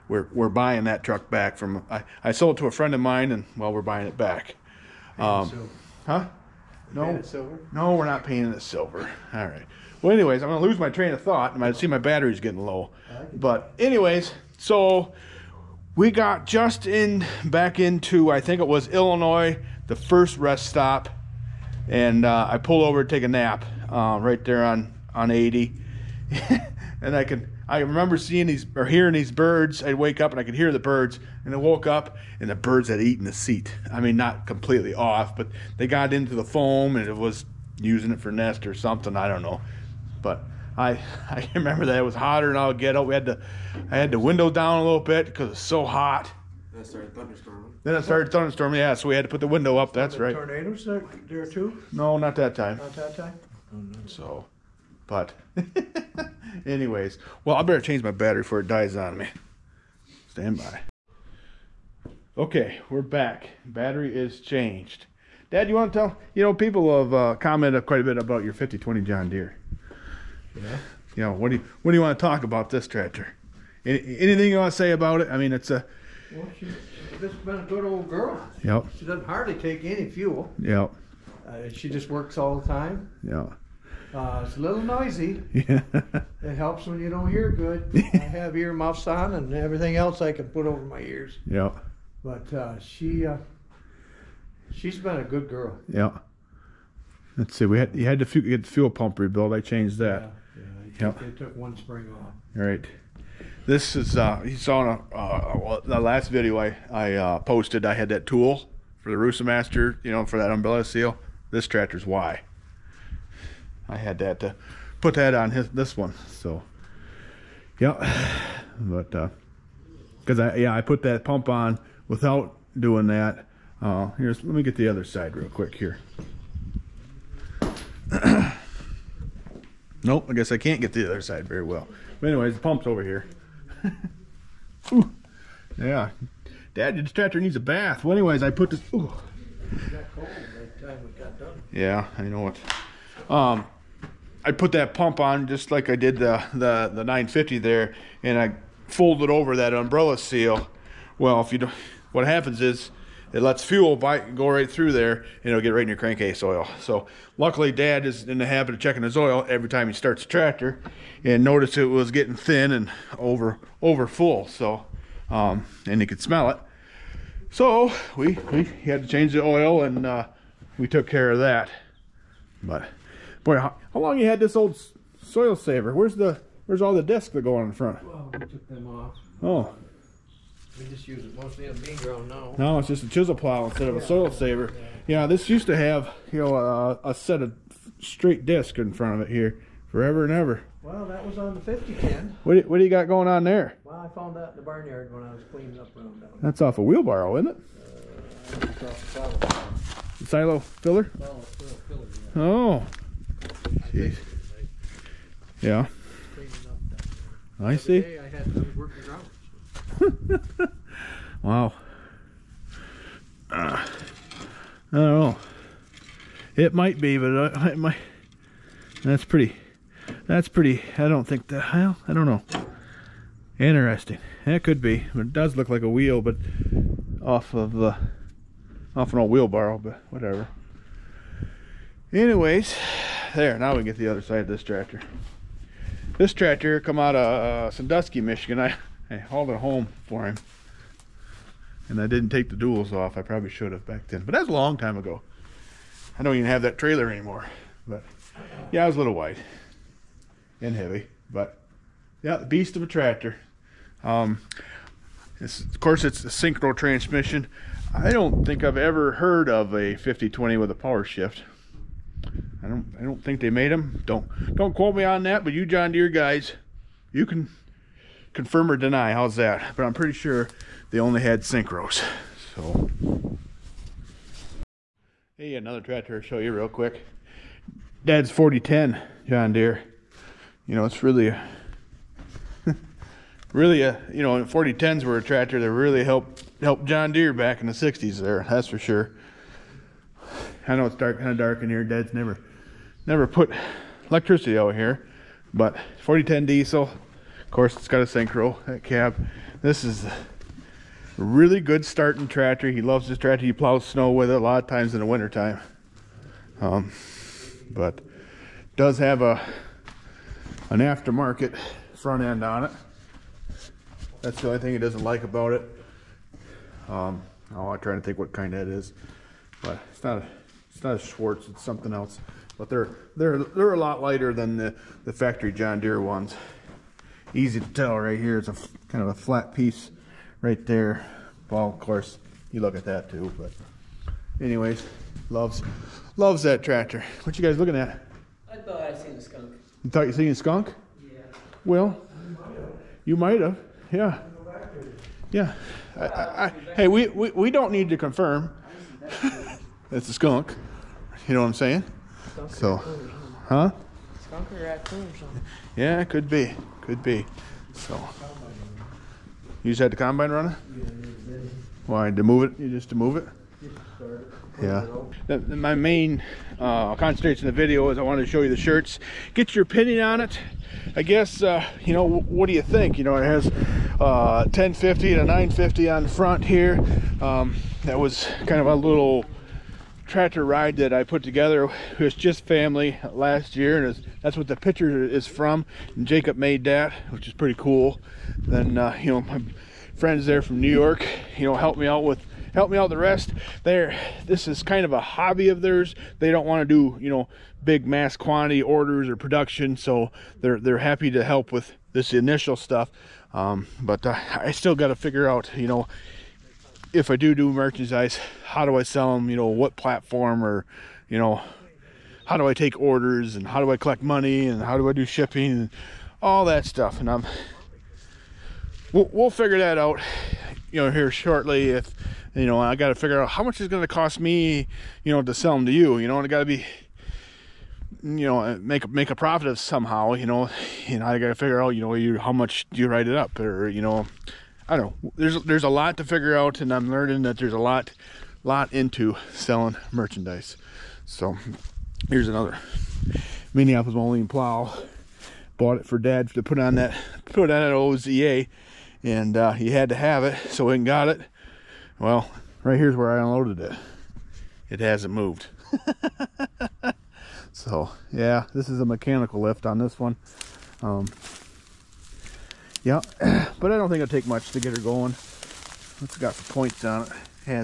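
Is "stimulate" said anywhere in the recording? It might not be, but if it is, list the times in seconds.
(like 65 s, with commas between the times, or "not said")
not said.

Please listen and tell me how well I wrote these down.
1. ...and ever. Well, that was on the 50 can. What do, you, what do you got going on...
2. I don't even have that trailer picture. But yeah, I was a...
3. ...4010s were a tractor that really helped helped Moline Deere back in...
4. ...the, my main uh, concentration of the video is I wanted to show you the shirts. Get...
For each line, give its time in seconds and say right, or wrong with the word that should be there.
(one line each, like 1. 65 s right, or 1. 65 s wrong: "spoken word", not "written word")
1. 190 s right
2. 246 s wrong: "anymore", not "picture"
3. 284 s wrong: "John", not "Moline"
4. 365 s right.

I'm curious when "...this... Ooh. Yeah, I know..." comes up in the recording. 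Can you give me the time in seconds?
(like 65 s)
138 s.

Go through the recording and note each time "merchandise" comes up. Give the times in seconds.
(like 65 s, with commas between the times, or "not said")
407 s, 439 s.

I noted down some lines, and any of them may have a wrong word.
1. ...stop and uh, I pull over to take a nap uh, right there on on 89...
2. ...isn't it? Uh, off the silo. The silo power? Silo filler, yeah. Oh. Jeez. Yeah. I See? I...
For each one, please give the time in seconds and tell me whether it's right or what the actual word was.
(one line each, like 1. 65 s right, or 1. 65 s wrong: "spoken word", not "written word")
1. 20 s wrong: "80", not "89"
2. 197 s wrong: "filler", not "power".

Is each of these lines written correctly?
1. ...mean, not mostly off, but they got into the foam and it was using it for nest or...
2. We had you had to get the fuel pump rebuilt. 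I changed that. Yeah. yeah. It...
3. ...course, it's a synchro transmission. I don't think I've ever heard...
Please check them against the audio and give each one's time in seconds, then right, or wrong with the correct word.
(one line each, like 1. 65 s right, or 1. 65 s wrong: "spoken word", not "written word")
1. 34 s wrong: "completely", not "mostly"
2. 97 s right
3. 255 s right.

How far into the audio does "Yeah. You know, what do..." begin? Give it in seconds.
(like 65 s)
70 s.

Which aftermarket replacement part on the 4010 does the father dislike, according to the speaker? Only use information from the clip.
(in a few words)
Front end.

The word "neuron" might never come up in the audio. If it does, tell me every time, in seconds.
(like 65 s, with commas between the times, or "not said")
not said.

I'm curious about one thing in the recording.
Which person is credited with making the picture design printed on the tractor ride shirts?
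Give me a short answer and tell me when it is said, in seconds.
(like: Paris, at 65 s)
Jacob, at 386 s.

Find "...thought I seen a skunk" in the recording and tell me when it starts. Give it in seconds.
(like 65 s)
338 s.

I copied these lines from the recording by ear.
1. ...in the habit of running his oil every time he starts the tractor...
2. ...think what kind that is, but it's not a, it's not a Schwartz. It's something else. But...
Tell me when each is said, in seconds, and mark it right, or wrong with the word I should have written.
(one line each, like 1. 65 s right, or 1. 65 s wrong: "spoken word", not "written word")
1. 158 s wrong: "checking", not "running"
2. 318 s right.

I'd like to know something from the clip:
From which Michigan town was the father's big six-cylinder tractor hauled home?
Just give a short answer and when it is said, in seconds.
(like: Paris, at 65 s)
Sandusky, at 237 s.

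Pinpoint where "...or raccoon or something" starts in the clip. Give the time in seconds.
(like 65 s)
354 s.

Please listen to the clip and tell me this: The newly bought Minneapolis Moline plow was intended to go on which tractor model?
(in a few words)
OZA.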